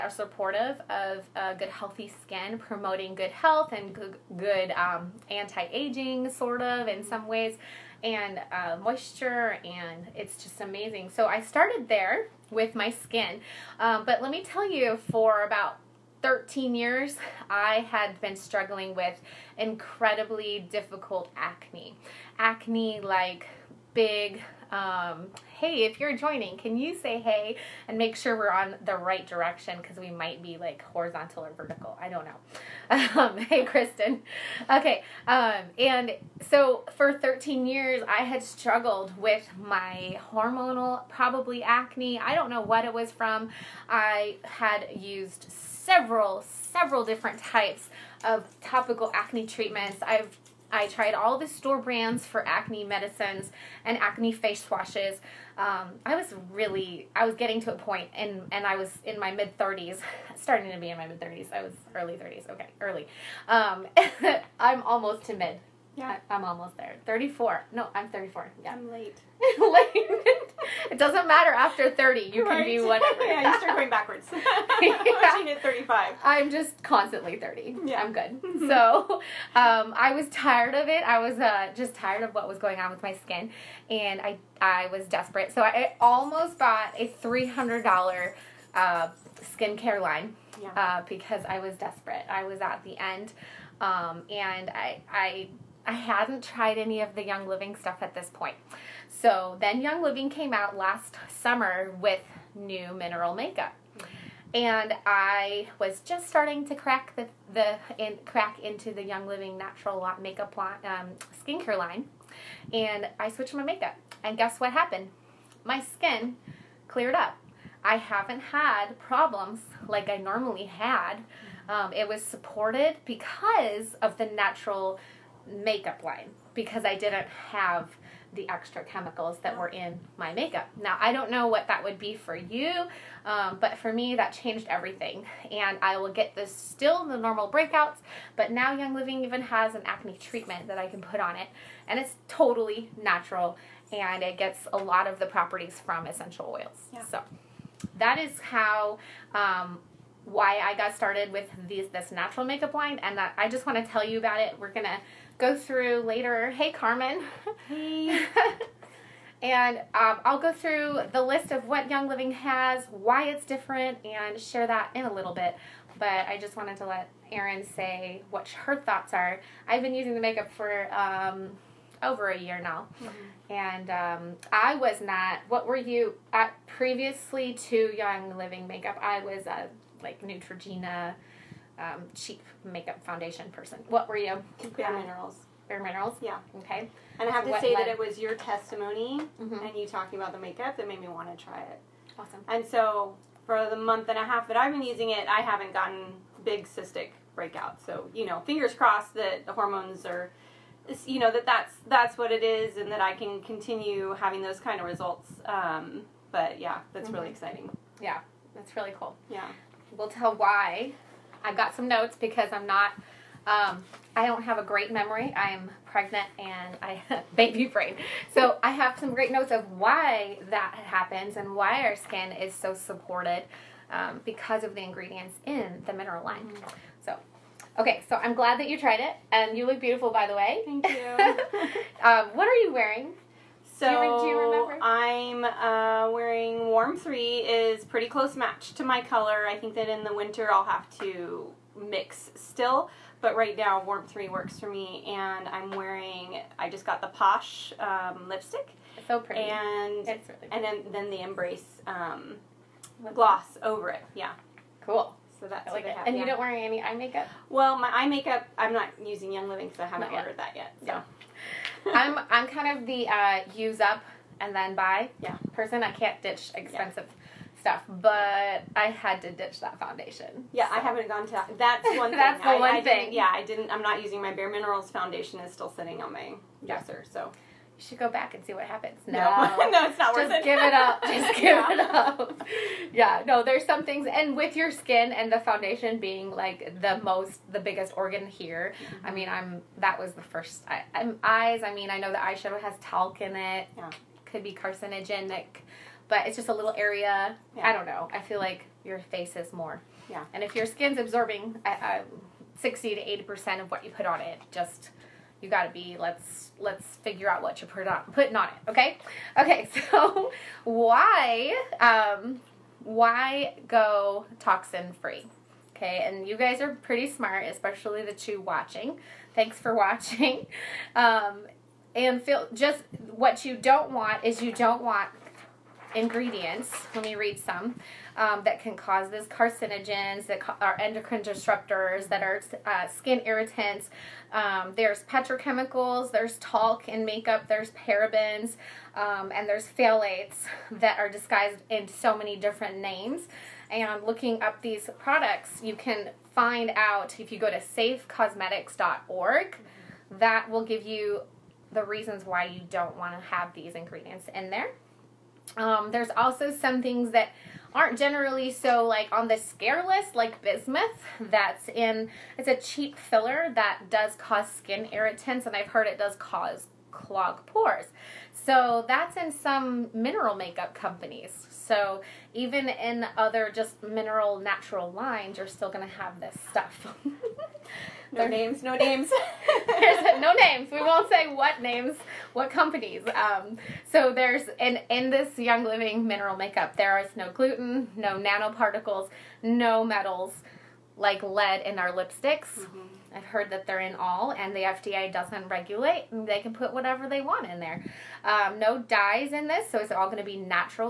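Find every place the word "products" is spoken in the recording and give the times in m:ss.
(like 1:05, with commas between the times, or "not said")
5:44.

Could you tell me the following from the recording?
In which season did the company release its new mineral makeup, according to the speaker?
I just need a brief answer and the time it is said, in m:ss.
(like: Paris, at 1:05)
last summer, at 1:40.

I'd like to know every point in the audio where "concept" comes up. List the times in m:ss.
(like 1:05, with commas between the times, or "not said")
not said.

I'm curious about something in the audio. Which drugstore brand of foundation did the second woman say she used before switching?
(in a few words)
Neutrogena.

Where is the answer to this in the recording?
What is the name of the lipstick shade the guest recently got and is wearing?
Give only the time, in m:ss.
4:07.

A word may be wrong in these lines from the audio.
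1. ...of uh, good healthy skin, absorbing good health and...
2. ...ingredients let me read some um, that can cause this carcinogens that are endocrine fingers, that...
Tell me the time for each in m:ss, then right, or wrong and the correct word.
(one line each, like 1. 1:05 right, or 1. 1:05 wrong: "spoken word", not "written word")
1. 0:00 wrong: "promoting", not "absorbing"
2. 5:25 wrong: "disruptors", not "fingers".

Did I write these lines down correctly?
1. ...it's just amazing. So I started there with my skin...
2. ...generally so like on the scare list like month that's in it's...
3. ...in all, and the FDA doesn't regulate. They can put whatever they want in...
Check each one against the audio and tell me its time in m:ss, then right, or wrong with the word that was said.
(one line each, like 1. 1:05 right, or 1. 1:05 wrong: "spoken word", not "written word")
1. 0:10 right
2. 5:57 wrong: "bismuth", not "month"
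3. 6:33 right.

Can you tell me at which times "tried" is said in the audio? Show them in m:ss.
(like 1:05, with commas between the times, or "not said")
0:50, 1:36, 3:48.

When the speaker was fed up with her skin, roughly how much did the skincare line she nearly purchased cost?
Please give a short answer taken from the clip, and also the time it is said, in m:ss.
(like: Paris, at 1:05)
$300, at 1:27.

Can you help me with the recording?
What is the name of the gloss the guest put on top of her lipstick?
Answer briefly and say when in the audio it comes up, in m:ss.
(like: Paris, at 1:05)
Embrace, at 4:11.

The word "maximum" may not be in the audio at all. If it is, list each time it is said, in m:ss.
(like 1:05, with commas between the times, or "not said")
not said.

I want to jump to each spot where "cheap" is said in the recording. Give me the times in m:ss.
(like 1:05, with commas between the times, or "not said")
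3:02, 6:02.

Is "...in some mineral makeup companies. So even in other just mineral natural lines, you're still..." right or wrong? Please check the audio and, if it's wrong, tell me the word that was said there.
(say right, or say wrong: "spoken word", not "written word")
right.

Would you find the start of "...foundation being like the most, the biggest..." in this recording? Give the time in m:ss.
4:45.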